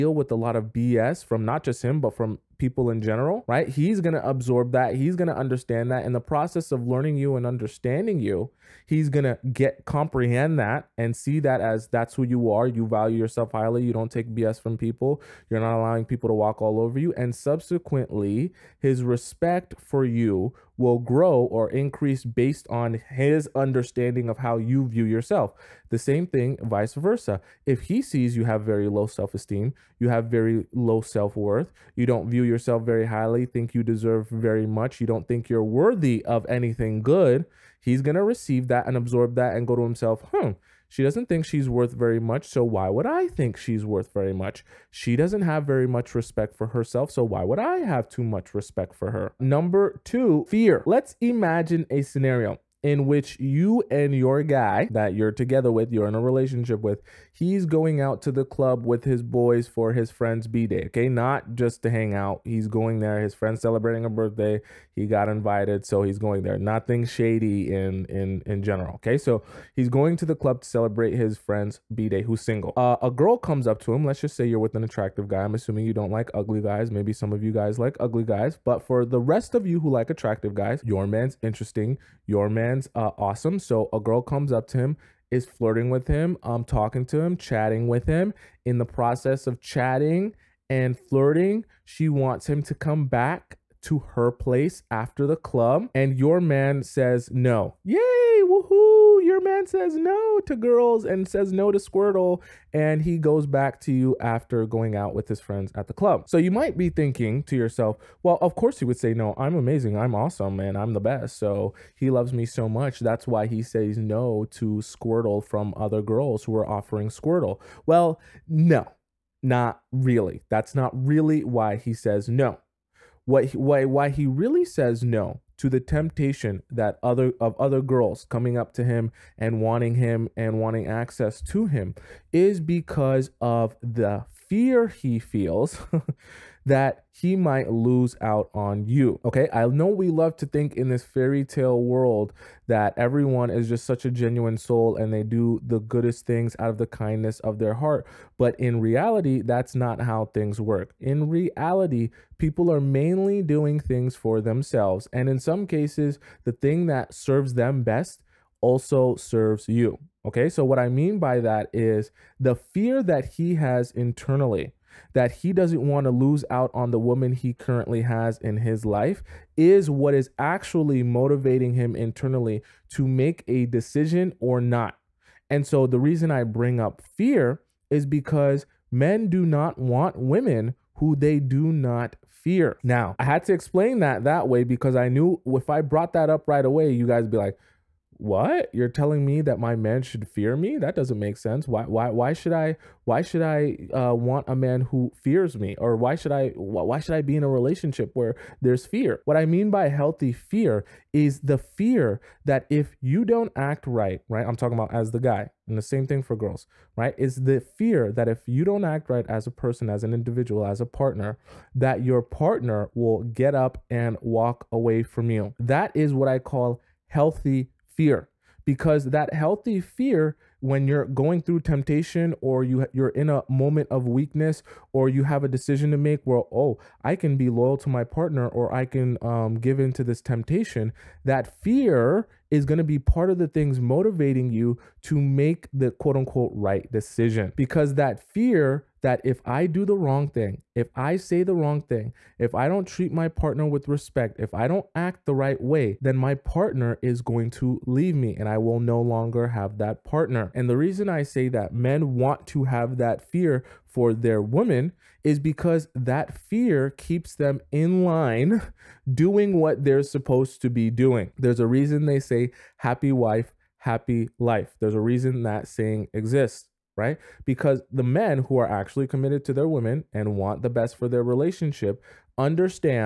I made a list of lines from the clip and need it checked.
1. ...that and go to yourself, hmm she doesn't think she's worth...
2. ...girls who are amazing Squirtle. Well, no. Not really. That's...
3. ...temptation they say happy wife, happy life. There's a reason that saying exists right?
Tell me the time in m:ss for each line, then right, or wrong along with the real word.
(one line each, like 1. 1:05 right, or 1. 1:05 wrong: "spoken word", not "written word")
1. 0:39 wrong: "himself", not "yourself"
2. 1:56 wrong: "offering", not "amazing"
3. 4:21 wrong: "reason", not "temptation".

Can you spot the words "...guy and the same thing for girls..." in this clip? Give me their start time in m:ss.
3:25.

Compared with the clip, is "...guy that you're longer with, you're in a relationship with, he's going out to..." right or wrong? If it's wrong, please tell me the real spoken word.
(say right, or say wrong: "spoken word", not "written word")
wrong: "together", not "longer".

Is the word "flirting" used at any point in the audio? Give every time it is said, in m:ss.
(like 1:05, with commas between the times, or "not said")
1:25, 1:30.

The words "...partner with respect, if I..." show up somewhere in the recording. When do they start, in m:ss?
4:03.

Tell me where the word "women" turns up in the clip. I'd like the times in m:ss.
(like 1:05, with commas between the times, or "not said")
3:00, 4:29.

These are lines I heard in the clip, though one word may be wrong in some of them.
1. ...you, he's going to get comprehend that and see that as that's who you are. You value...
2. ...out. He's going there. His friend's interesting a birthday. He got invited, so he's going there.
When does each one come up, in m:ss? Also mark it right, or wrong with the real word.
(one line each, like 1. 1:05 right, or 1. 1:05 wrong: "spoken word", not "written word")
1. 0:08 right
2. 1:02 wrong: "celebrating", not "interesting".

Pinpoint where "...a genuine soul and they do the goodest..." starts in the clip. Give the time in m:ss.
2:24.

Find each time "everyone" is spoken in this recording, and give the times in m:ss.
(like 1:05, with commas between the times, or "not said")
2:22.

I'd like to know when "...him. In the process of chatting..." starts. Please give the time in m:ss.
1:28.